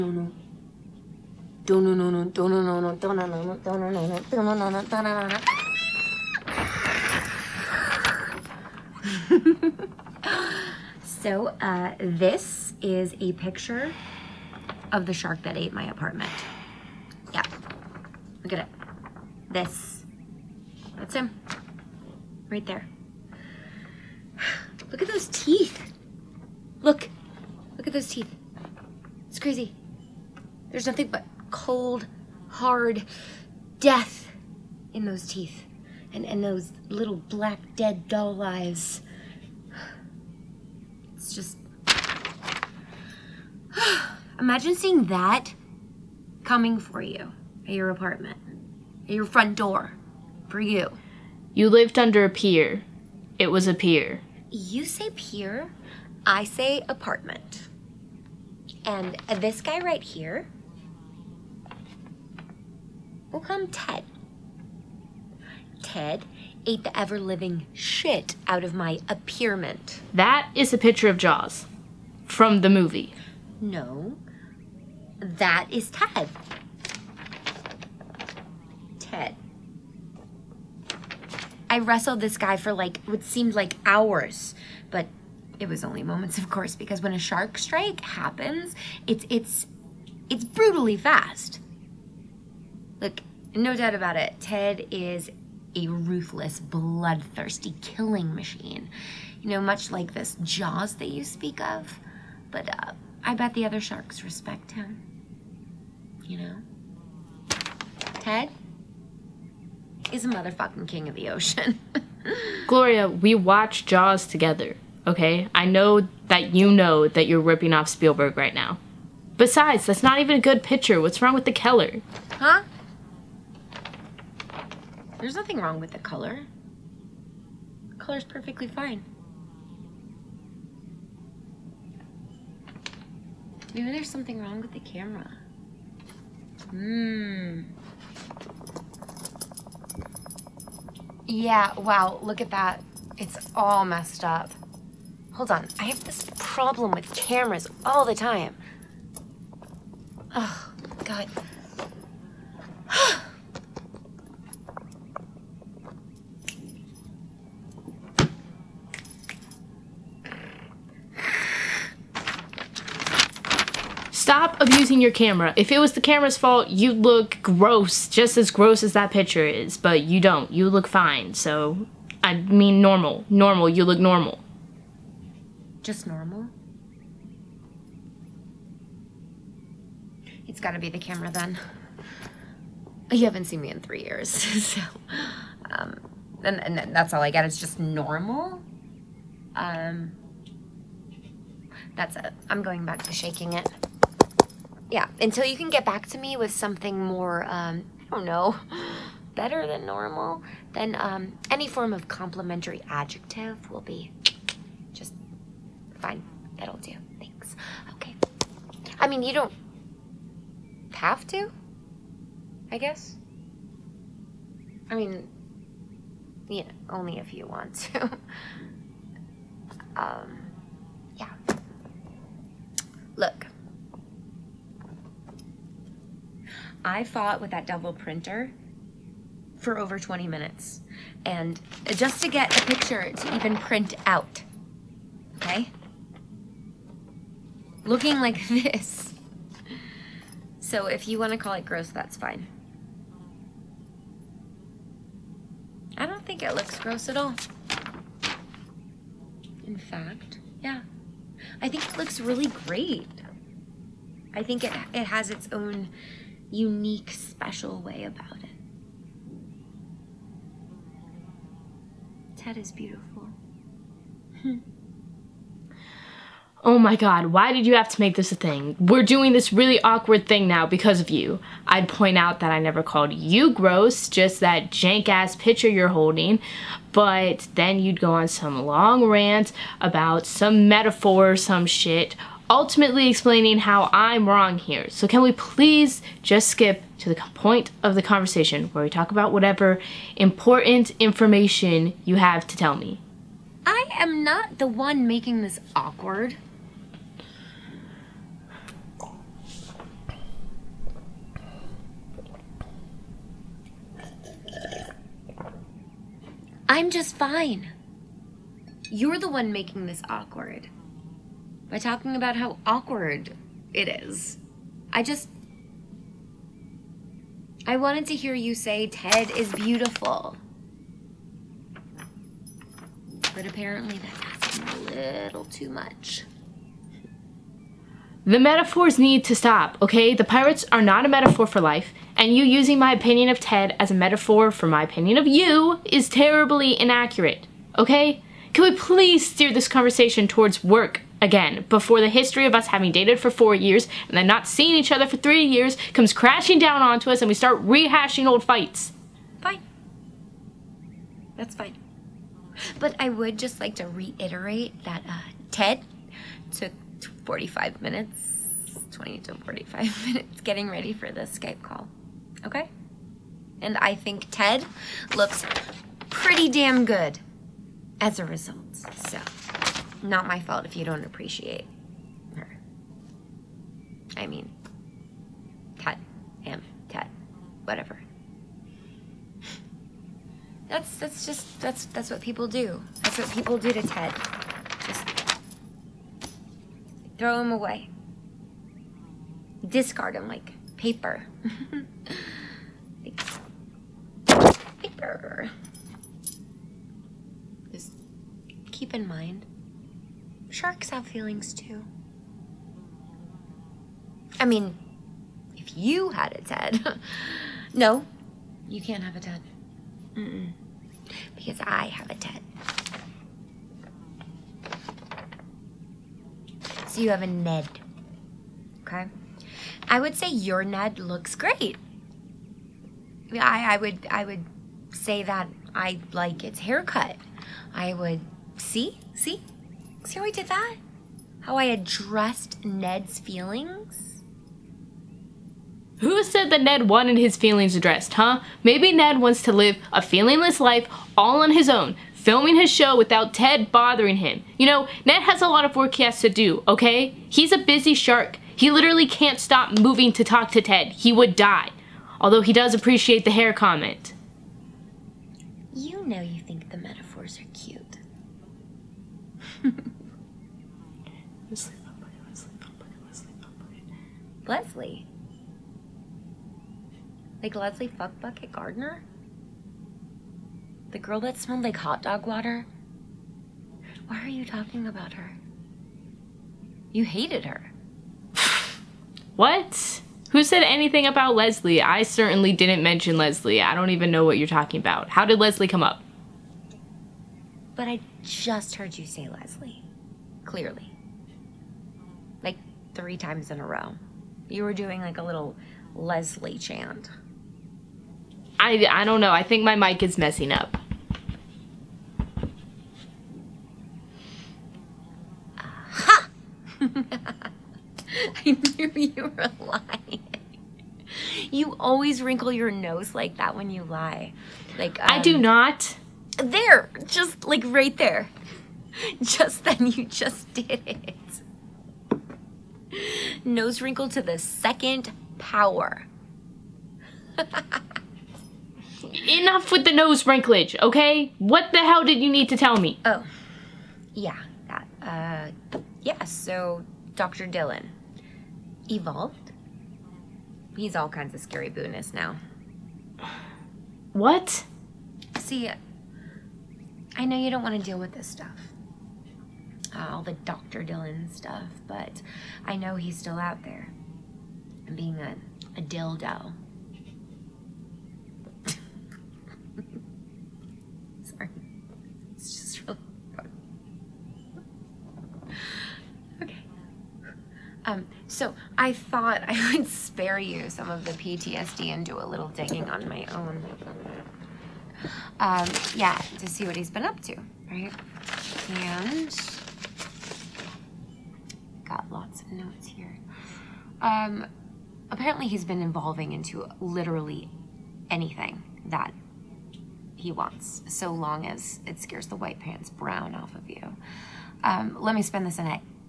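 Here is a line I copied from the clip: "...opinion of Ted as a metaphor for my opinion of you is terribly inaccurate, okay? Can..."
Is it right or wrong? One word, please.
right.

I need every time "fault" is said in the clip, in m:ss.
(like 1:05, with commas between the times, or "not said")
2:46, 6:10.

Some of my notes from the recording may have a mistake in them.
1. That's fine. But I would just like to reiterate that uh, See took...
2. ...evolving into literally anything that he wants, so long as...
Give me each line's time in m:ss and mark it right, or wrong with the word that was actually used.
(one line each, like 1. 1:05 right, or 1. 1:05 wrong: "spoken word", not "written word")
1. 5:51 wrong: "Ted", not "See"
2. 9:45 right.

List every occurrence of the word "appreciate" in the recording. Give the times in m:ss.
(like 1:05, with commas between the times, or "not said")
6:11, 7:32.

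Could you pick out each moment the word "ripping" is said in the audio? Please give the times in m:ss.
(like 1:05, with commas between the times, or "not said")
1:57.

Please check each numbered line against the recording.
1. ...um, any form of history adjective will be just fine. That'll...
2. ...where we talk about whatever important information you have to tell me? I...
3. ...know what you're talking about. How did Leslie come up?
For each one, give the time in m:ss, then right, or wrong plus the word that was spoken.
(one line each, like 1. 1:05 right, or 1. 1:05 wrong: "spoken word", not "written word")
1. 3:20 wrong: "complimentary", not "history"
2. 4:48 right
3. 8:04 right.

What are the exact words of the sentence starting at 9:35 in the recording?
Um, yeah, to see what he's been up to, right?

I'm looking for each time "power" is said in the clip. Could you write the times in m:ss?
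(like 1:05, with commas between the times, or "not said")
8:45.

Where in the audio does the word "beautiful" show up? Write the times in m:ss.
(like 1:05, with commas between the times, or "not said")
4:22, 5:19.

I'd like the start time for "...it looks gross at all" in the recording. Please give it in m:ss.
4:06.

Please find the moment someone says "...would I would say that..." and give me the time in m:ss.
7:03.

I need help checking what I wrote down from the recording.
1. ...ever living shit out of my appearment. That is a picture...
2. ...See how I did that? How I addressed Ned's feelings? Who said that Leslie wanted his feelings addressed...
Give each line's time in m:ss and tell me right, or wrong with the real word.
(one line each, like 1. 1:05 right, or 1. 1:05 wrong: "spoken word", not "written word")
1. 1:06 right
2. 7:10 wrong: "Ned", not "Leslie".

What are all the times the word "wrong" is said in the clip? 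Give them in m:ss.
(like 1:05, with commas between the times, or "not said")
2:01, 2:05, 2:14, 4:44.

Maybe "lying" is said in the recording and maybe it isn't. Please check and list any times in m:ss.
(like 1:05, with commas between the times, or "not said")
8:29.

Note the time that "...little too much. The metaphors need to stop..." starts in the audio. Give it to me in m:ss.
5:25.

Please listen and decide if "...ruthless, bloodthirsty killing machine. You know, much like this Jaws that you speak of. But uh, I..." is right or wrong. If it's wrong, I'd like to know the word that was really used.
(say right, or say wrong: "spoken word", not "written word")
right.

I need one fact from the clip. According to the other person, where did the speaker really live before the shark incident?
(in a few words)
under a pier.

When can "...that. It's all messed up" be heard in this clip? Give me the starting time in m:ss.
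2:22.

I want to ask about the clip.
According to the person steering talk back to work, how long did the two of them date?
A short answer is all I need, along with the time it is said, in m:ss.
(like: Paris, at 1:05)
4 years, at 5:43.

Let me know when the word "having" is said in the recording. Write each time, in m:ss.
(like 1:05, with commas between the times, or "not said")
5:42.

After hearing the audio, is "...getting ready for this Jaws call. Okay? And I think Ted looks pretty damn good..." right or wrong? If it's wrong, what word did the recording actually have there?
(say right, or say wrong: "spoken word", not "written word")
wrong: "Skype", not "Jaws".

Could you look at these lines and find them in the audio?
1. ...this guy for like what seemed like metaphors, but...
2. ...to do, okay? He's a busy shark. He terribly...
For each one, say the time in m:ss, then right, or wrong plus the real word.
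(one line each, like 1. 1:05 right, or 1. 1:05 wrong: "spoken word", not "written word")
1. 1:22 wrong: "hours", not "metaphors"
2. 7:26 wrong: "literally", not "terribly".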